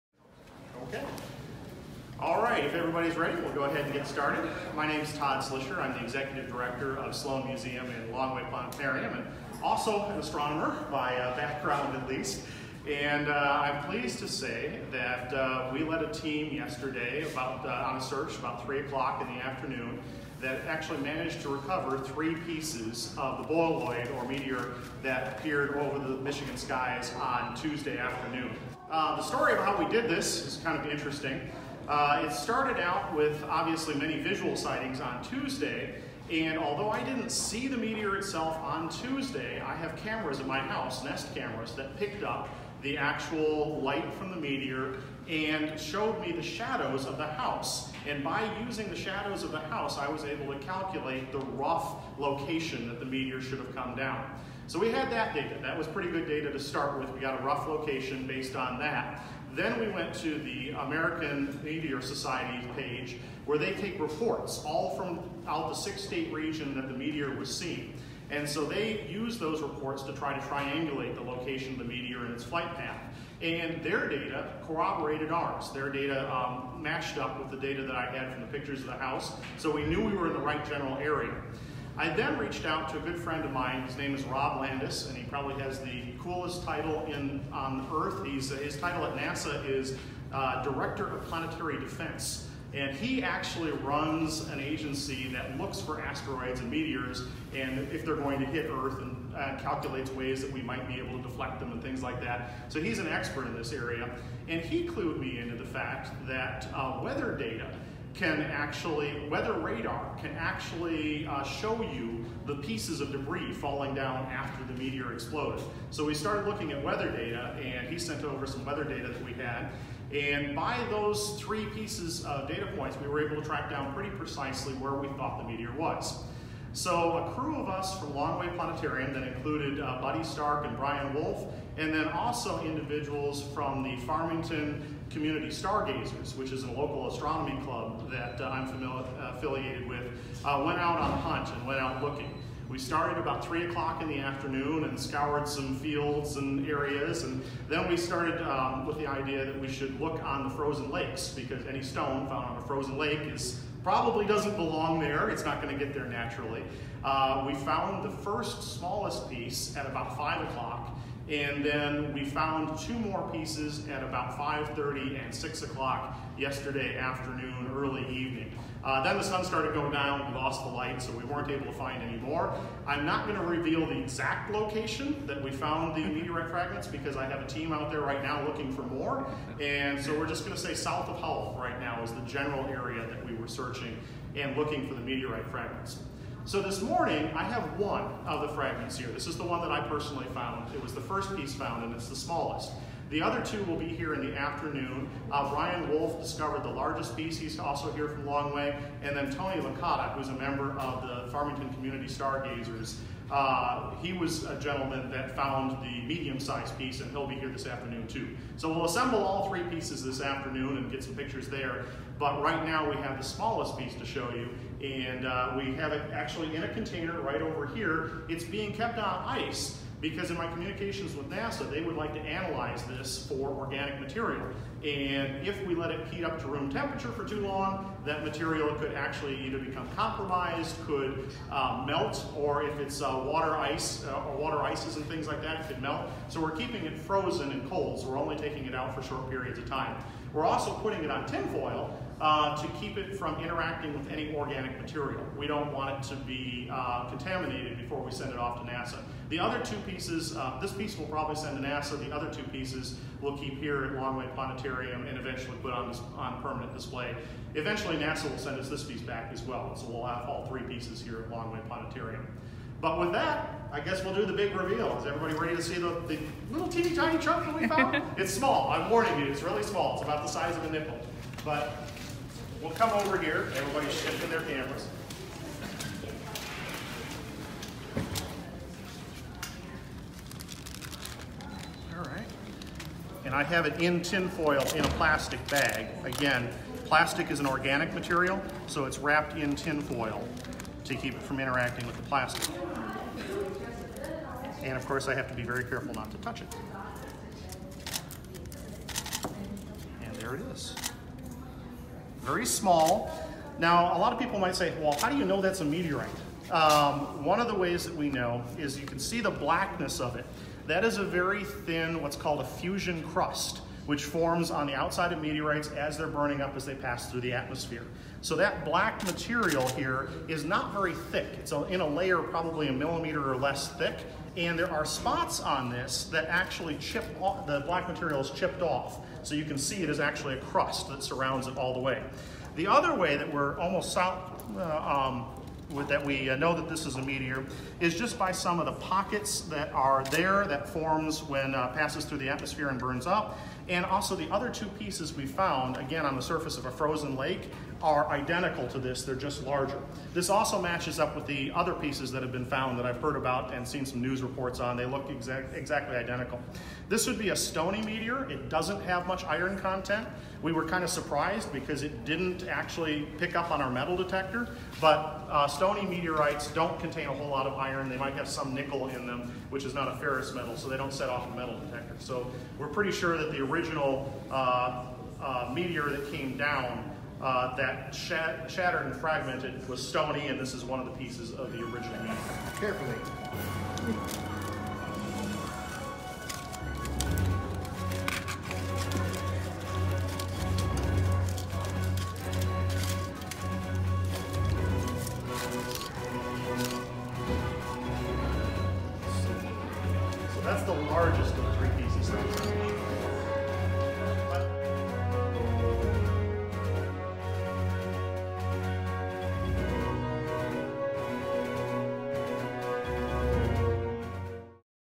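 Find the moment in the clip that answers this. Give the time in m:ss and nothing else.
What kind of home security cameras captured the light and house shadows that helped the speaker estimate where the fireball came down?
0:41.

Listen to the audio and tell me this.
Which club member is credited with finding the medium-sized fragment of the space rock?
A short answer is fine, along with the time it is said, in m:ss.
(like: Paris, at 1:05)
Tony Licata, at 3:19.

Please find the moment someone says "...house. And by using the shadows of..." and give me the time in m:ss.
0:47.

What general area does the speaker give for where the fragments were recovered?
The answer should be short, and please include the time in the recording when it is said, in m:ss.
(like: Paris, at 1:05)
South of Howell, at 3:00.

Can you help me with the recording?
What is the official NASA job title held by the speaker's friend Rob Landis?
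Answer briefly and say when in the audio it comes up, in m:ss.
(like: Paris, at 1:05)
Director of Planetary Defense, at 1:30.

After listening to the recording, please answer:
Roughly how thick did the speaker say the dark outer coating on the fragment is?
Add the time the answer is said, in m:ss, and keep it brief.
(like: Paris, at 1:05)
A millimeter or less, at 5:22.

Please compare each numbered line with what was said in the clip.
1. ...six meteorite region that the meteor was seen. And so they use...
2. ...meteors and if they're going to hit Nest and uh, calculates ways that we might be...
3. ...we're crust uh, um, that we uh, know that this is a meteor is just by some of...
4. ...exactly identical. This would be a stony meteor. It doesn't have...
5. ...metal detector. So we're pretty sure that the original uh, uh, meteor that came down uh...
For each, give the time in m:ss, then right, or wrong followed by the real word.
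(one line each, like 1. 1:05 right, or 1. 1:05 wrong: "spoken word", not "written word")
1. 1:05 wrong: "state", not "meteorite"
2. 1:36 wrong: "Earth", not "Nest"
3. 5:33 wrong: "almost", not "crust"
4. 5:55 right
5. 6:11 right.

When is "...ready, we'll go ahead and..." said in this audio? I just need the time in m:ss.
0:03.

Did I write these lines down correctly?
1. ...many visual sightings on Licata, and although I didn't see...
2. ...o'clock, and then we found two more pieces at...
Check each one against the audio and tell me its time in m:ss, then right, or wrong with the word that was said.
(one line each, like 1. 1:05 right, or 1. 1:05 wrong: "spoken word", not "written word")
1. 0:33 wrong: "Tuesday", not "Licata"
2. 2:40 right.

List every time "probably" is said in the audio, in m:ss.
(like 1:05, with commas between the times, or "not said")
1:25, 2:33, 4:11, 5:22.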